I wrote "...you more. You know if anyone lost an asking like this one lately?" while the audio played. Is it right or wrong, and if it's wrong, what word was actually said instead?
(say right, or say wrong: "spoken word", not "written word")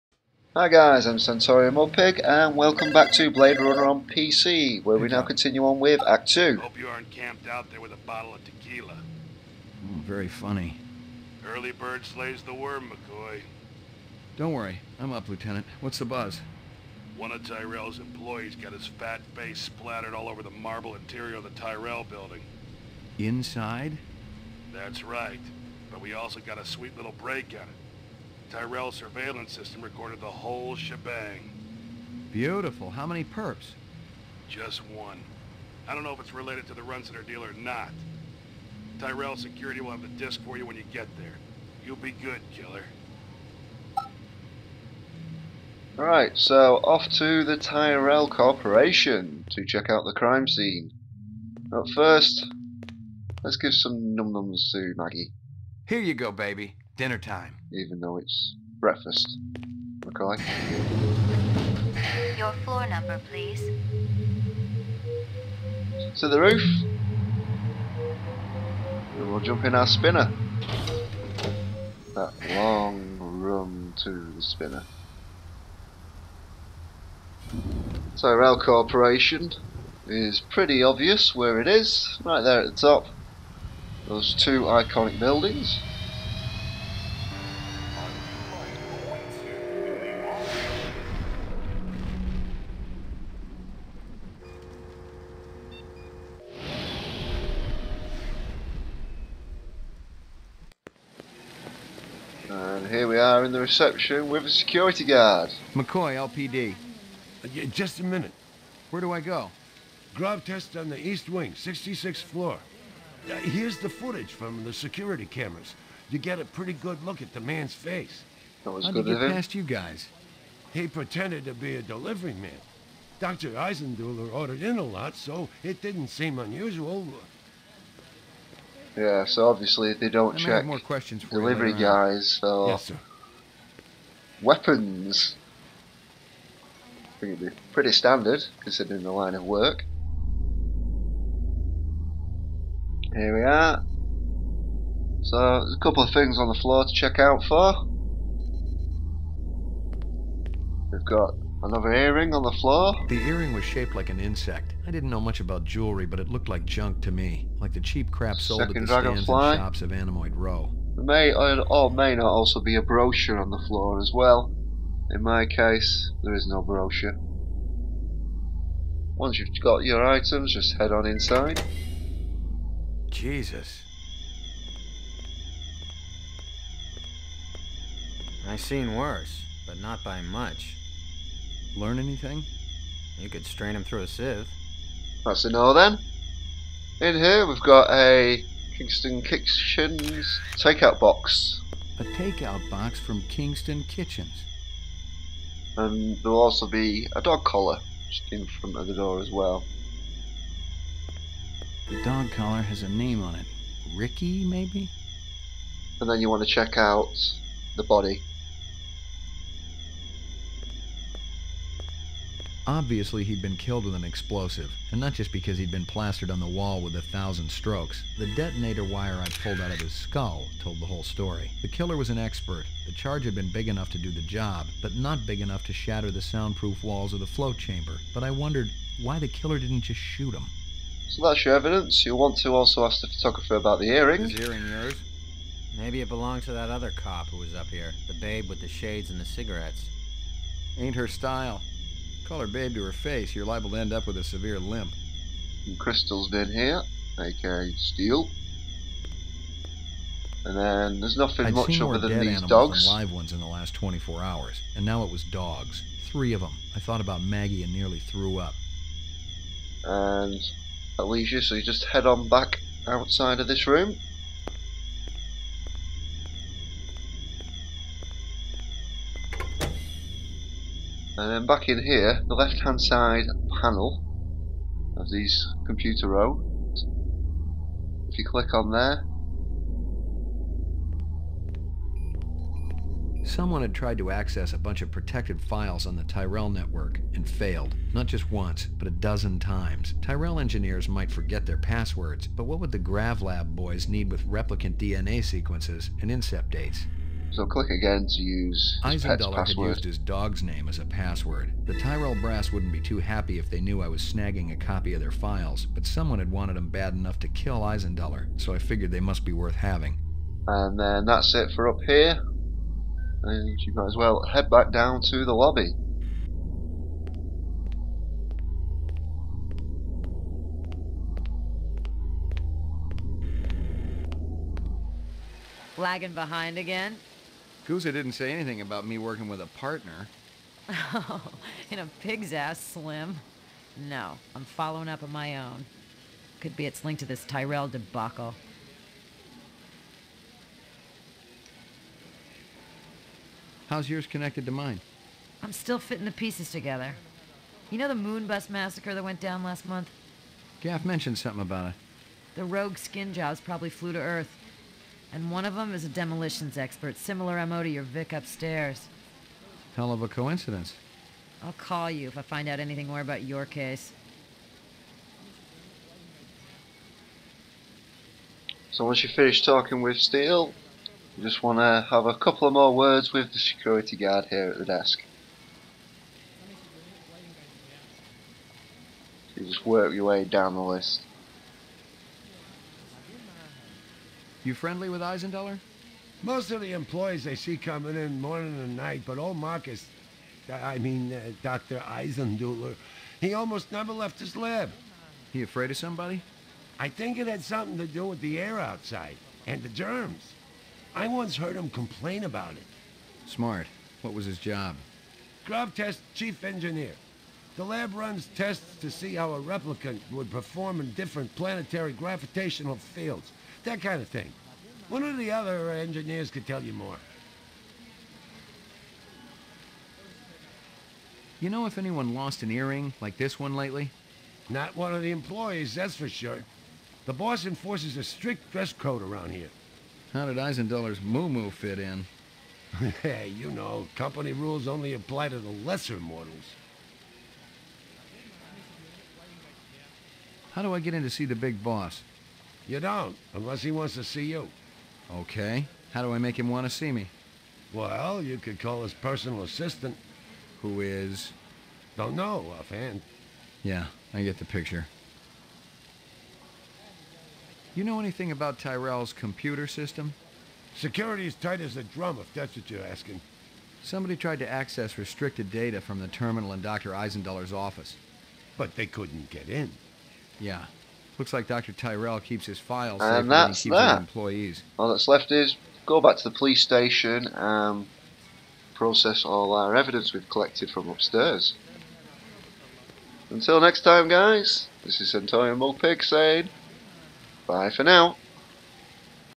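wrong: "earring", not "asking".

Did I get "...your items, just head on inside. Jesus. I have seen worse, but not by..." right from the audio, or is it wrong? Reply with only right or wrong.
right.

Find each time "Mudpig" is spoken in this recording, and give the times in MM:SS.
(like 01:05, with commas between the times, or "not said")
00:01, 08:05.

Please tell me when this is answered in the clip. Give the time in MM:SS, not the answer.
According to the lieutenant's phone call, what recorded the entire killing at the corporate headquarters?
00:28.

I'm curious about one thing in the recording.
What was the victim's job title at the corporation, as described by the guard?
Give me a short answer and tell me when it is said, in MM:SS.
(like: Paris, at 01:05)
Grav Test chief engineer, at 06:45.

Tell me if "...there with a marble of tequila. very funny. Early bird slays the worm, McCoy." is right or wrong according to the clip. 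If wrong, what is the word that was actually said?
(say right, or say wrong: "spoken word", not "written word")
wrong: "bottle", not "marble".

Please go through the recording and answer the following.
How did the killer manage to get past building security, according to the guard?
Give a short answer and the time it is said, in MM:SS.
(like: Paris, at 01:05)
Pretended to be a delivery man, at 02:01.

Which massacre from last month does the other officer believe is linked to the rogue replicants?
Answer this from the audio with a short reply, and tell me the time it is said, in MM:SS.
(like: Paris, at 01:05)
Moon bus massacre, at 05:47.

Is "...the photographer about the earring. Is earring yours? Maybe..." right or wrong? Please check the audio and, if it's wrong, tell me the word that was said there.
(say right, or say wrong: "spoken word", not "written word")
right.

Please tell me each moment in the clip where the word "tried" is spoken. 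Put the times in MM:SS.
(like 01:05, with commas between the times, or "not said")
04:43, 07:44.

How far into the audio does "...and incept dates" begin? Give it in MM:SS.
04:56.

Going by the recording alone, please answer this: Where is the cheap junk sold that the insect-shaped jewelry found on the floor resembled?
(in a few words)
Animoid Row.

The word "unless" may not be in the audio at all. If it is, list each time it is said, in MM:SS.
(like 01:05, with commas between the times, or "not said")
07:23.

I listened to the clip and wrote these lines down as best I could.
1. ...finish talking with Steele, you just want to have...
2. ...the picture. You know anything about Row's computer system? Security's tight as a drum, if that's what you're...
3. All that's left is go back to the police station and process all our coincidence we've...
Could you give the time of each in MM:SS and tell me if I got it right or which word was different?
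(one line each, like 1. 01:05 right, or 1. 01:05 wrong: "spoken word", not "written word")
1. 06:09 right
2. 07:34 wrong: "Tyrell", not "Row"
3. 07:54 wrong: "evidence", not "coincidence".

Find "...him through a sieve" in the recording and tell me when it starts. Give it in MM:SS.
03:03.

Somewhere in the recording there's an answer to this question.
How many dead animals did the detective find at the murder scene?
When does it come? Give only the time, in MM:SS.
04:16.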